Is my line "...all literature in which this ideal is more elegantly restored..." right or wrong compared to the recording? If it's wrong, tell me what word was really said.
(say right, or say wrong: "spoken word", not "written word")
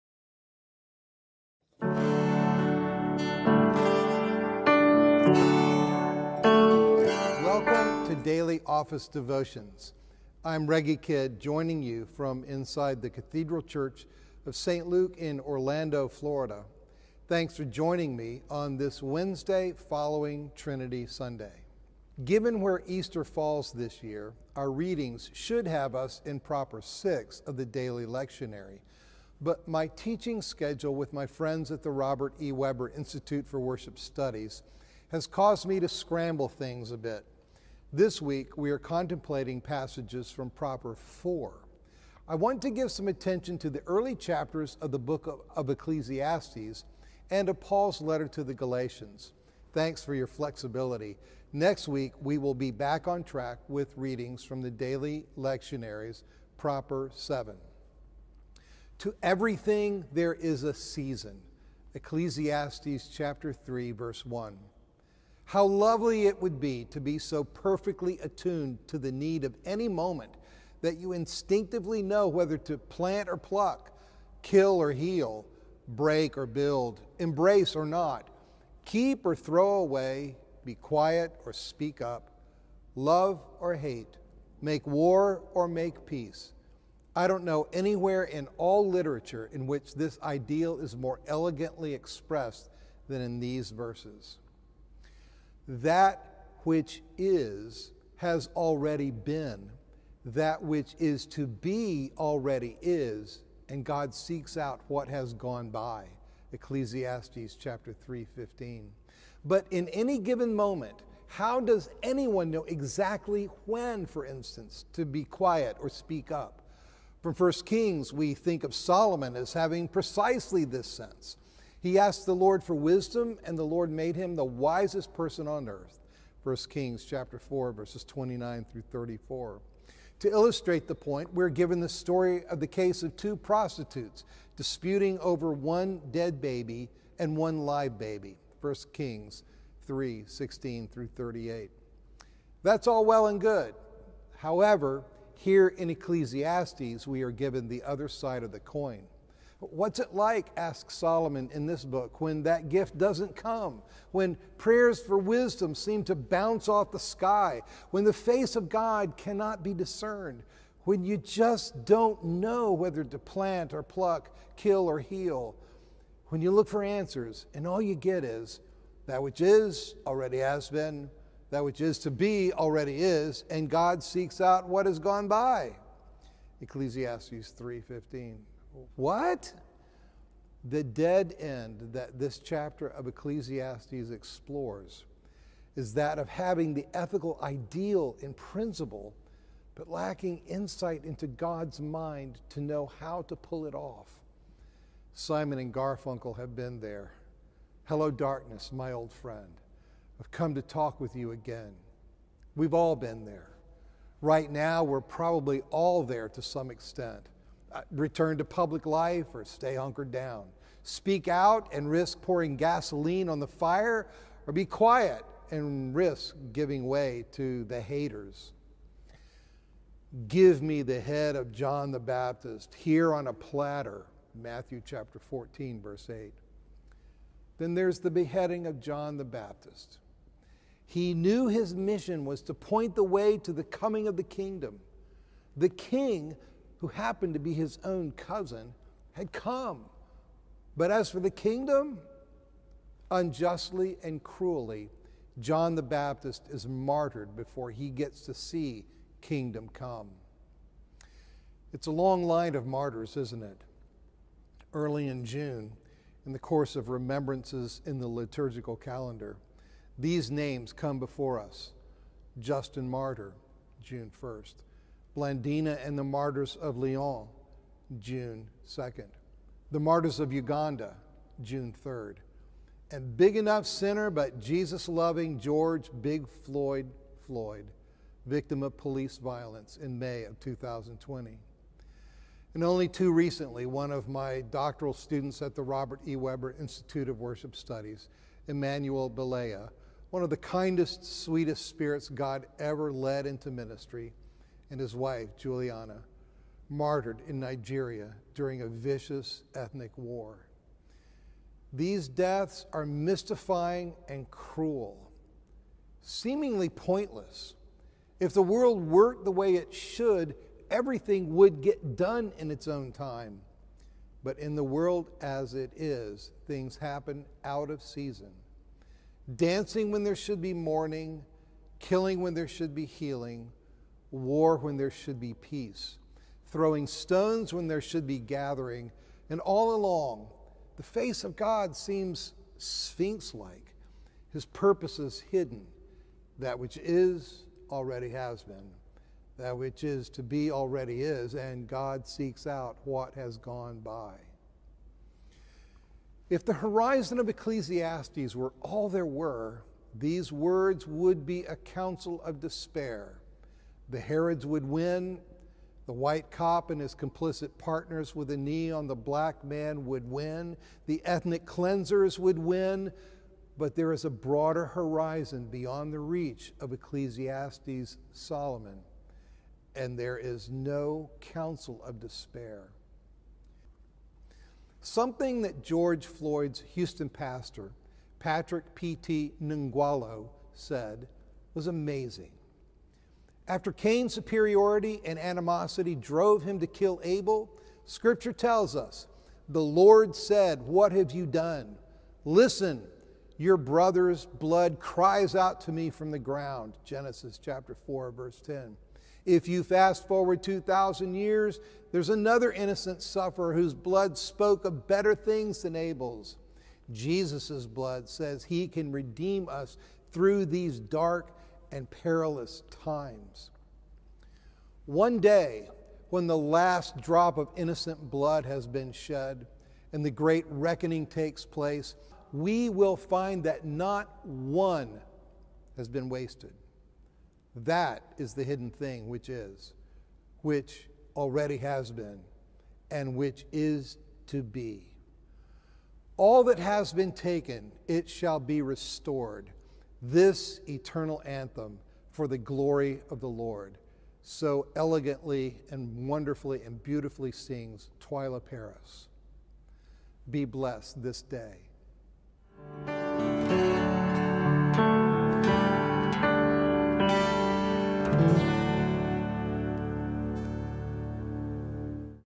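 wrong: "expressed", not "restored".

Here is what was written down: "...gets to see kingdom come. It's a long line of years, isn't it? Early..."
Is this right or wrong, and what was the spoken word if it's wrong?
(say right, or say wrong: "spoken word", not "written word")
wrong: "martyrs", not "years".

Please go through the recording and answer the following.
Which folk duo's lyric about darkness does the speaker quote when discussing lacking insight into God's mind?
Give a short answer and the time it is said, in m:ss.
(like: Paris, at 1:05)
Simon and Garfunkel, at 3:15.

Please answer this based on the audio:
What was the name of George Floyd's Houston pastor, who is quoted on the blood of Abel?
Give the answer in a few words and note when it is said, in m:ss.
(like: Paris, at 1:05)
Patrick P.T. Ngwolo, at 6:18.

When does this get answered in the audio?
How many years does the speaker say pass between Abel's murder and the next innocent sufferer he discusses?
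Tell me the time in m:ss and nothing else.
6:40.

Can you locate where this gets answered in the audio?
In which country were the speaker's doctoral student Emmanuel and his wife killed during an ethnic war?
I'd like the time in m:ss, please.
4:57.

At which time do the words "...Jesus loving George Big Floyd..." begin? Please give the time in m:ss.
4:34.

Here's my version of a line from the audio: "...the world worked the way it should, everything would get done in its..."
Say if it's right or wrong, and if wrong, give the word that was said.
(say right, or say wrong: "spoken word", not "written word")
right.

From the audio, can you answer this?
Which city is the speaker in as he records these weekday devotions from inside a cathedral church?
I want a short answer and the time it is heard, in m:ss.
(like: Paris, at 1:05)
Orlando, at 0:15.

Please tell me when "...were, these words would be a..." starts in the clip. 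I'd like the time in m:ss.
5:49.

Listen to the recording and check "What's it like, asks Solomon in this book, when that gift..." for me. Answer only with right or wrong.
right.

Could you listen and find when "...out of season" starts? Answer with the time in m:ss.
5:17.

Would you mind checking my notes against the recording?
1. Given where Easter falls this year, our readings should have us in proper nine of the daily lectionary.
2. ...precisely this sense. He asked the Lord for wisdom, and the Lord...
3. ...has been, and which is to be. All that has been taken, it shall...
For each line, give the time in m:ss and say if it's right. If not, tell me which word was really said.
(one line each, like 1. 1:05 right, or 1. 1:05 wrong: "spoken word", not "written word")
1. 0:22 wrong: "six", not "nine"
2. 1:59 right
3. 7:11 right.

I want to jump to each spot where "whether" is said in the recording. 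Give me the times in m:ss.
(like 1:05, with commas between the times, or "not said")
1:12, 2:42.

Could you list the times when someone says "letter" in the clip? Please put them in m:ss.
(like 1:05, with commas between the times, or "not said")
0:48.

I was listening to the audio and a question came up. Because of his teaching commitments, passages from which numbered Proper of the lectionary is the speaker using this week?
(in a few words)
Proper 4.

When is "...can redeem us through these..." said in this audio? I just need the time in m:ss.
6:48.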